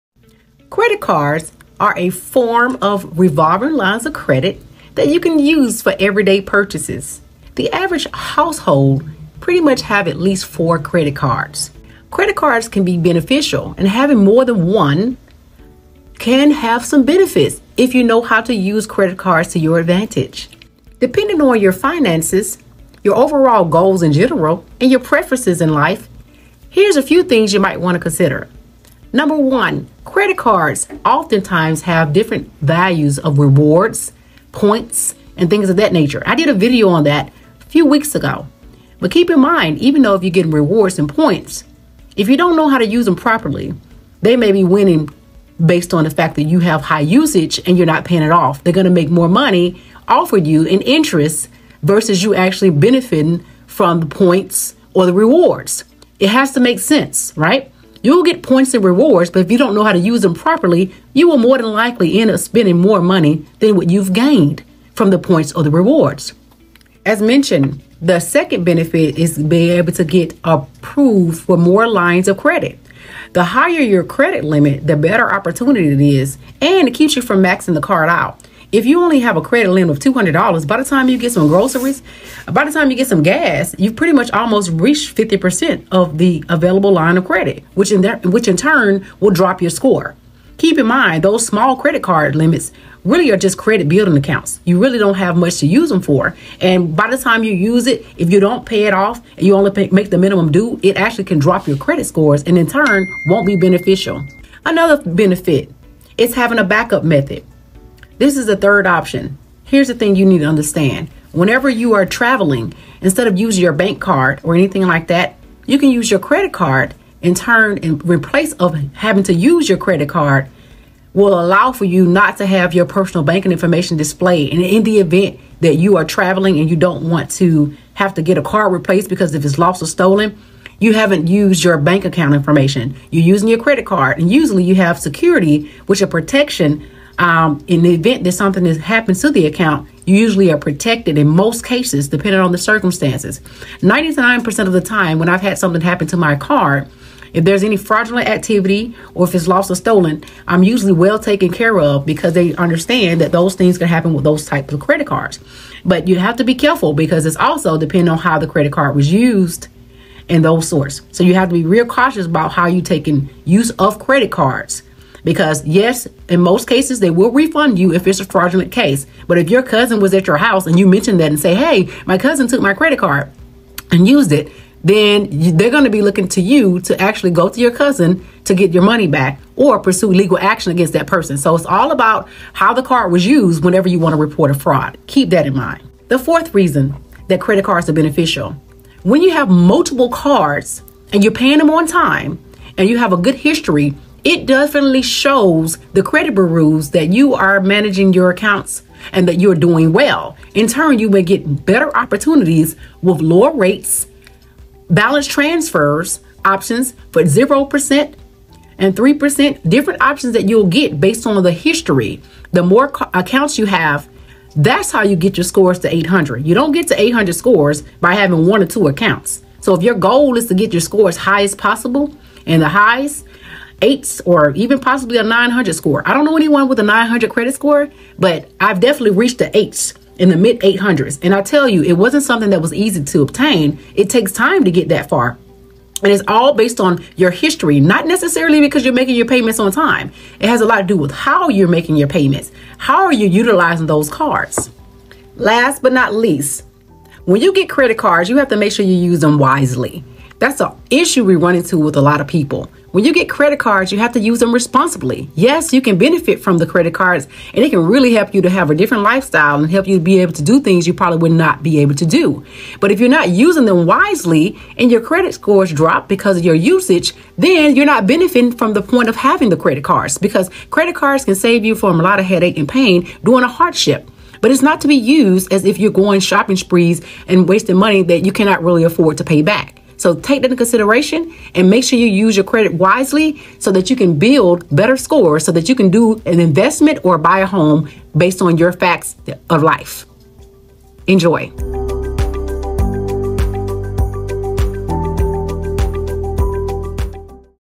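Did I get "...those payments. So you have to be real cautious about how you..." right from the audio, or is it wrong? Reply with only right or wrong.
wrong.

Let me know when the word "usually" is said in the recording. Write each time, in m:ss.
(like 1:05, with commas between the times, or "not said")
2:14, 2:20, 2:30.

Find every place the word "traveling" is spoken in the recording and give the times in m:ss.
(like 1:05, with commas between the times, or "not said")
1:52, 2:06.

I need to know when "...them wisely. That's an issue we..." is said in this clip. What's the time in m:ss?
4:09.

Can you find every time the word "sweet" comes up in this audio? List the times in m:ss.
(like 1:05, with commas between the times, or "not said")
not said.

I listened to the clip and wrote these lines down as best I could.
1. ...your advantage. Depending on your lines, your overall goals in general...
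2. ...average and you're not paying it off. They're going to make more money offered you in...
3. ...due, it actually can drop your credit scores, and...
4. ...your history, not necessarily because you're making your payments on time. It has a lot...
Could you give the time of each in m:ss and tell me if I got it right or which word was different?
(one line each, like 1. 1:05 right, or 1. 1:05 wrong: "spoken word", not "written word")
1. 0:19 wrong: "finances", not "lines"
2. 0:47 wrong: "usage", not "average"
3. 1:40 right
4. 3:57 right.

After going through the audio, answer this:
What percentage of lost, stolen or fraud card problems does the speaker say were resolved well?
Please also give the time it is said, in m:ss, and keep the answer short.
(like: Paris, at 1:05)
99%, at 2:23.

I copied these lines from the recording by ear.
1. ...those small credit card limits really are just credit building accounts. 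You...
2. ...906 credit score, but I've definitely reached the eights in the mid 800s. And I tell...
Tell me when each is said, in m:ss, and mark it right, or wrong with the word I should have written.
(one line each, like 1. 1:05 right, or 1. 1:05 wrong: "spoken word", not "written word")
1. 1:31 right
2. 3:46 wrong: "900", not "906".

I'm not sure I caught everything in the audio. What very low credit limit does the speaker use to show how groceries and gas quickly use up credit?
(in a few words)
$200.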